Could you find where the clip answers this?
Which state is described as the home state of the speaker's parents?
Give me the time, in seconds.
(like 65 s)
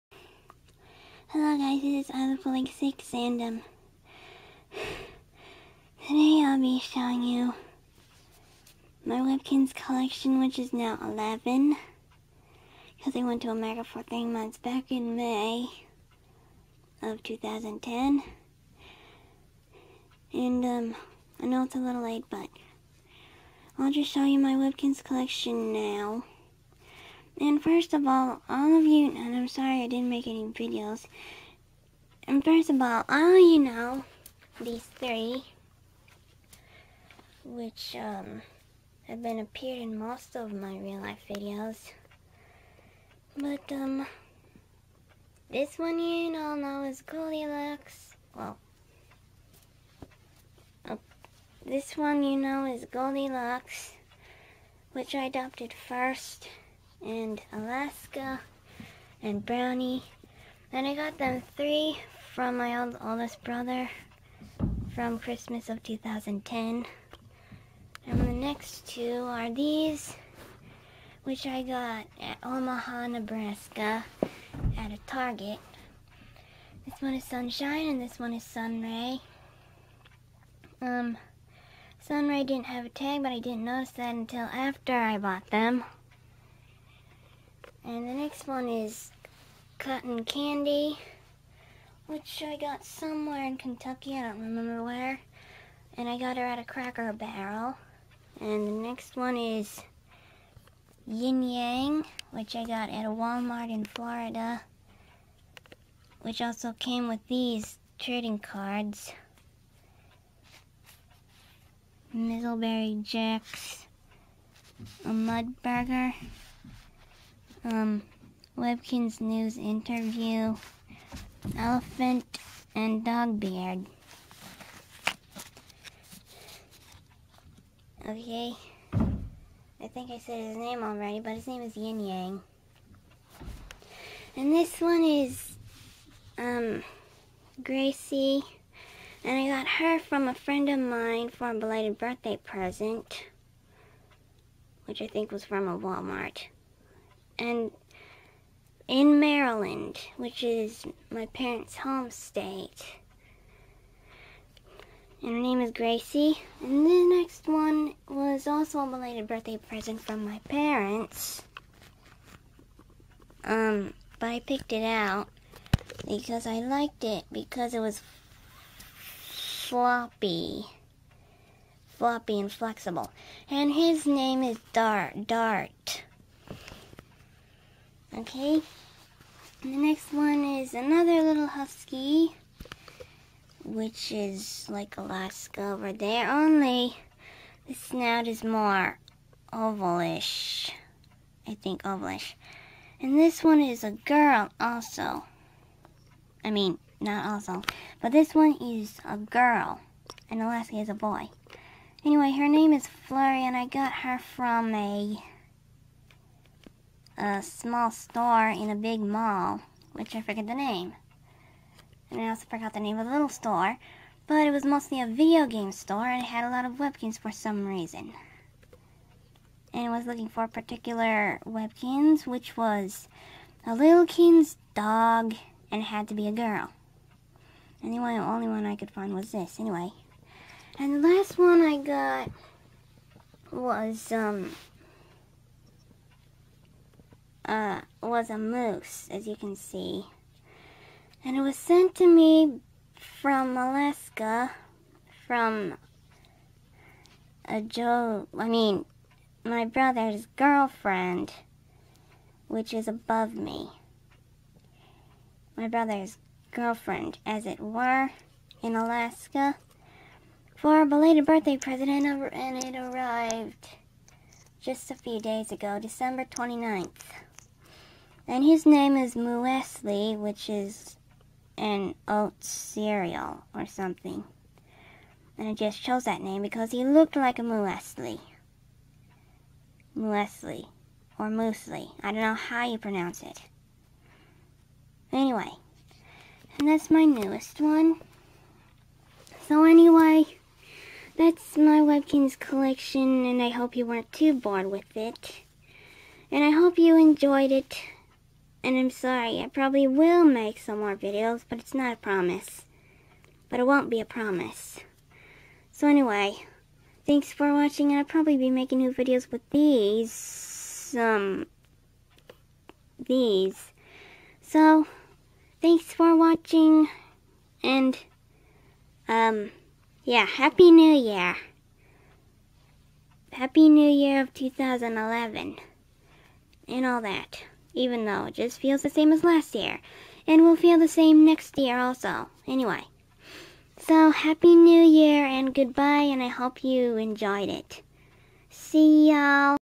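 149 s.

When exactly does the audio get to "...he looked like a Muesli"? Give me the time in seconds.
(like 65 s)
276 s.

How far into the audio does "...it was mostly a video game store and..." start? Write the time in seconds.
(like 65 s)
214 s.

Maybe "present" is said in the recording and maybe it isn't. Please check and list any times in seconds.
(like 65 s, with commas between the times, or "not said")
142 s, 159 s, 261 s.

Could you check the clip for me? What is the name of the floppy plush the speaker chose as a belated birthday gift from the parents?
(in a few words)
Dart Dart.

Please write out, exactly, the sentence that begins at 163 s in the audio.
Um, but I picked it out because I liked it because it was floppy.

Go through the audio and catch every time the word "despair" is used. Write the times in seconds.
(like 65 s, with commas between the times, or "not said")
not said.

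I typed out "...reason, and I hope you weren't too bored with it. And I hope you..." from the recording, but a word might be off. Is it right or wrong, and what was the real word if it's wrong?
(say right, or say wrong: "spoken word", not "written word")
wrong: "collection", not "reason".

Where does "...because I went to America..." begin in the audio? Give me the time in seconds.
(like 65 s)
12 s.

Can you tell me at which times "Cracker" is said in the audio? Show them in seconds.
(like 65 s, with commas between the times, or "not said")
96 s.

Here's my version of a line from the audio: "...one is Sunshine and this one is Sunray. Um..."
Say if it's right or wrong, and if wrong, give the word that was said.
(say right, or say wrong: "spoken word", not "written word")
right.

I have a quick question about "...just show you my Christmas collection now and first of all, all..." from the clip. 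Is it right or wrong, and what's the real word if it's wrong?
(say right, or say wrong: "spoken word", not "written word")
wrong: "Webkinz", not "Christmas".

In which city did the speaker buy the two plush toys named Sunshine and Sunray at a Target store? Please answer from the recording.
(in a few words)
Omaha, Nebraska.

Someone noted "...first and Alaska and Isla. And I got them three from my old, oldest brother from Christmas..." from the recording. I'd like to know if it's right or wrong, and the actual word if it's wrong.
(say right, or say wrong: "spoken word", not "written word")
wrong: "Brownie", not "Isla".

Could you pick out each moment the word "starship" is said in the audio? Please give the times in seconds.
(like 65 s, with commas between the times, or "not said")
not said.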